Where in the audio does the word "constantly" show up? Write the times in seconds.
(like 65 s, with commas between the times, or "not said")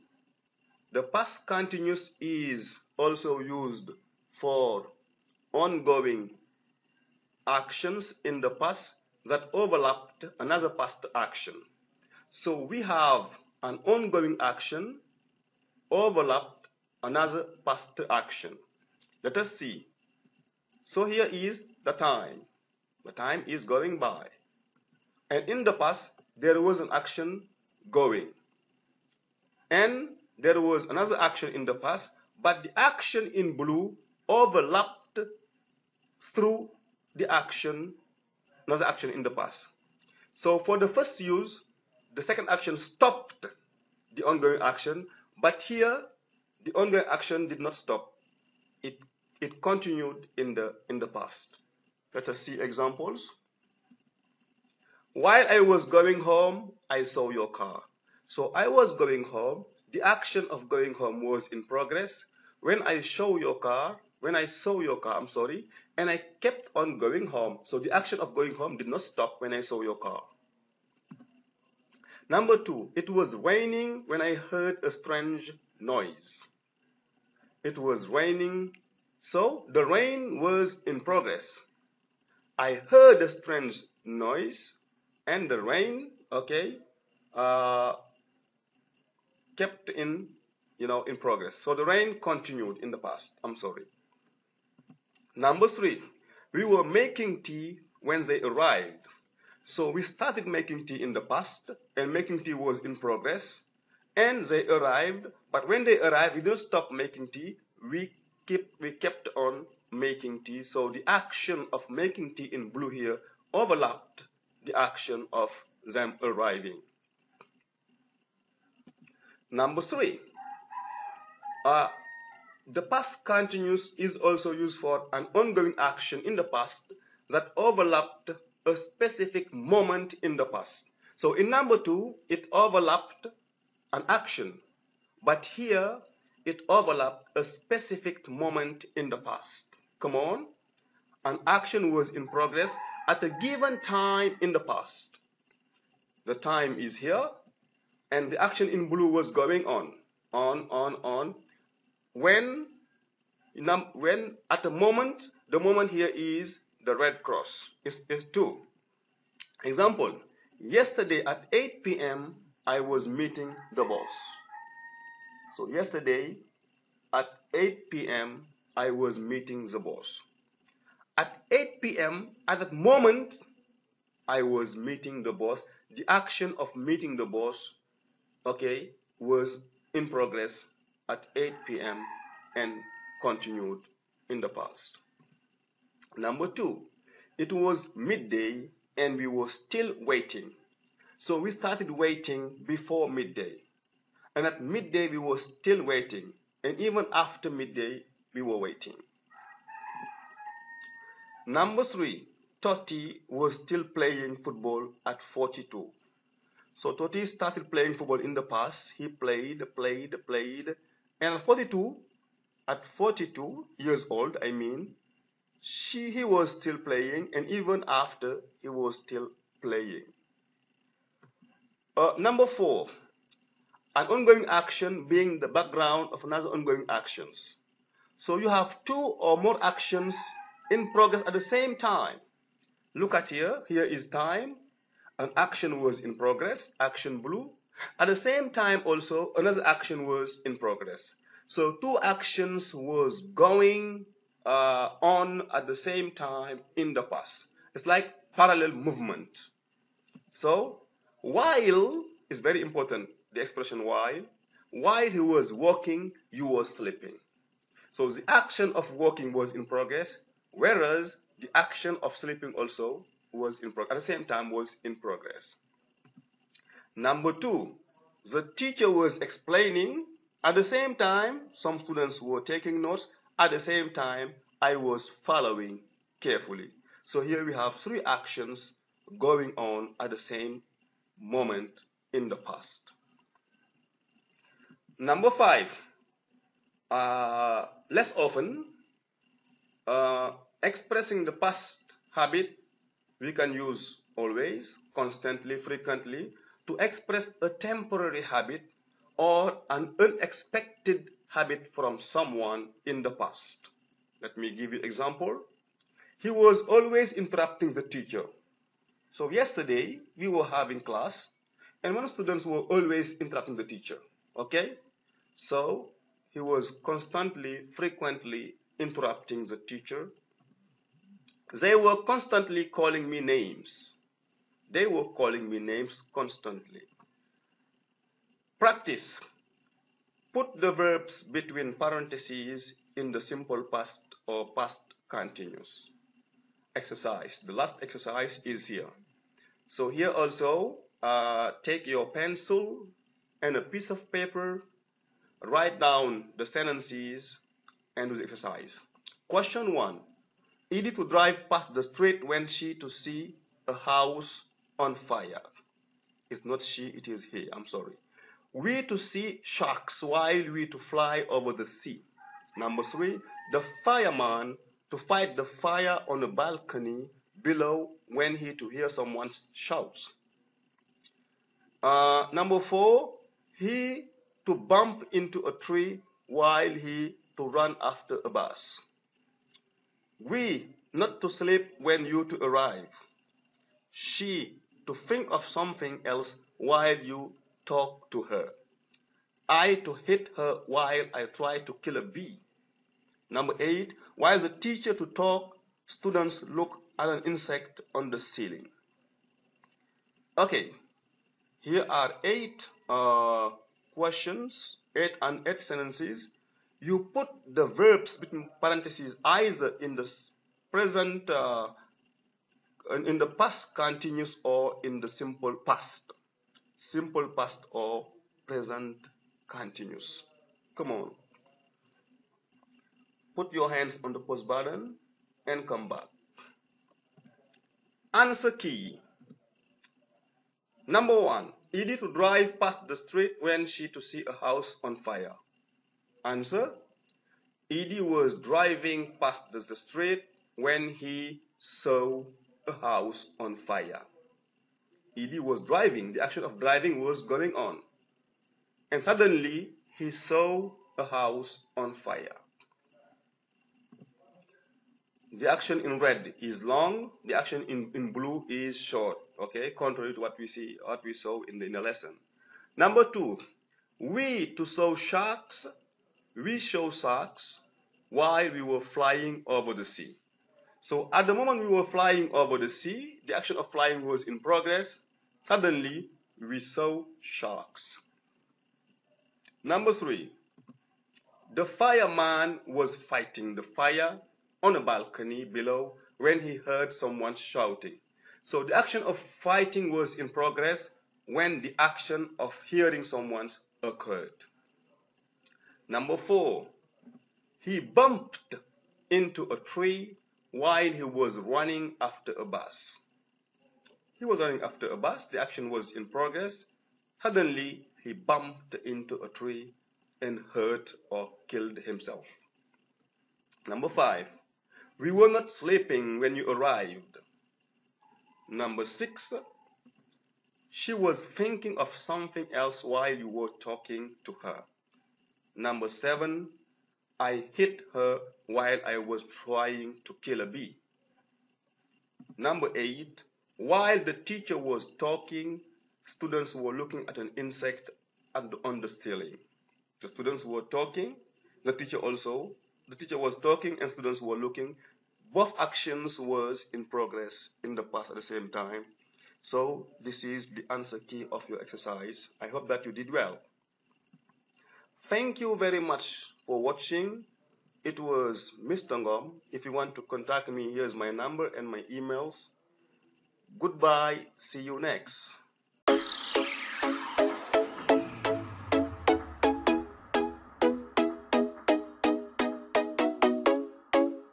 294 s, 316 s, 322 s, 326 s.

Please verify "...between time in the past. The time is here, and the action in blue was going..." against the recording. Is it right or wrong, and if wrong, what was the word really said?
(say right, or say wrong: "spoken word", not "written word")
wrong: "given", not "between".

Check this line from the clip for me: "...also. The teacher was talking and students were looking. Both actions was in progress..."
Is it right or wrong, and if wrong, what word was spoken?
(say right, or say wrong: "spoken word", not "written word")
right.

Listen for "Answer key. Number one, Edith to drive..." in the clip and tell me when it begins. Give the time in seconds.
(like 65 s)
428 s.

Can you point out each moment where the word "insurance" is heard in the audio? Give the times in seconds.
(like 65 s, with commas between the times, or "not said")
not said.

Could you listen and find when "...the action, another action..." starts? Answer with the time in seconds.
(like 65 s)
37 s.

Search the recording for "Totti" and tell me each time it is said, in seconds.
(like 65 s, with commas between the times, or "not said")
202 s, 206 s.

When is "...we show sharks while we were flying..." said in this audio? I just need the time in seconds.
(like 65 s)
466 s.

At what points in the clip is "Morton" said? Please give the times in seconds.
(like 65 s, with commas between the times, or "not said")
not said.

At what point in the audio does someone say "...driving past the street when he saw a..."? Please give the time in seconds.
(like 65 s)
438 s.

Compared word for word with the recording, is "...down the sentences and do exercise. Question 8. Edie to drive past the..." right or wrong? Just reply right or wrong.
wrong.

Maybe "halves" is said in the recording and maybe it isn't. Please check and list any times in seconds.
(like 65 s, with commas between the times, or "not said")
not said.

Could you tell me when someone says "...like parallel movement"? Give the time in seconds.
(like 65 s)
247 s.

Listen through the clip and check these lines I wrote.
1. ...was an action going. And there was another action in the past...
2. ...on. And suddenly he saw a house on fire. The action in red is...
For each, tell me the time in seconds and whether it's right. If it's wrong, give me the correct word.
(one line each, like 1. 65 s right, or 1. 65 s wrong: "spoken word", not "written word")
1. 26 s right
2. 447 s right.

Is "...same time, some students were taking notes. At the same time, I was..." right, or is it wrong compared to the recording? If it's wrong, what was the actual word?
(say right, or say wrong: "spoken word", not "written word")
right.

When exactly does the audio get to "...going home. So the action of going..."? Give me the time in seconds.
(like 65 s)
66 s.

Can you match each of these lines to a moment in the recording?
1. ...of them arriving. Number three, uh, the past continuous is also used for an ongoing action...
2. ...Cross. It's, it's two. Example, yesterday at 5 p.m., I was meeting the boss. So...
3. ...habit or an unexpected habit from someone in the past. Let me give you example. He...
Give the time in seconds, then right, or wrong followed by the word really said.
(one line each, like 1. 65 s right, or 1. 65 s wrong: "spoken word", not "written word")
1. 115 s right
2. 157 s wrong: "8", not "5"
3. 298 s right.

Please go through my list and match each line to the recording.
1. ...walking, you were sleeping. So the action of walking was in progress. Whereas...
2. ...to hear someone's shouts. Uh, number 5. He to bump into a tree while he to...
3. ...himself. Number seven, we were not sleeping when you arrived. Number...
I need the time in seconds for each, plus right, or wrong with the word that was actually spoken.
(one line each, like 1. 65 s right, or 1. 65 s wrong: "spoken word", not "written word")
1. 255 s right
2. 368 s wrong: "4", not "5"
3. 511 s wrong: "five", not "seven".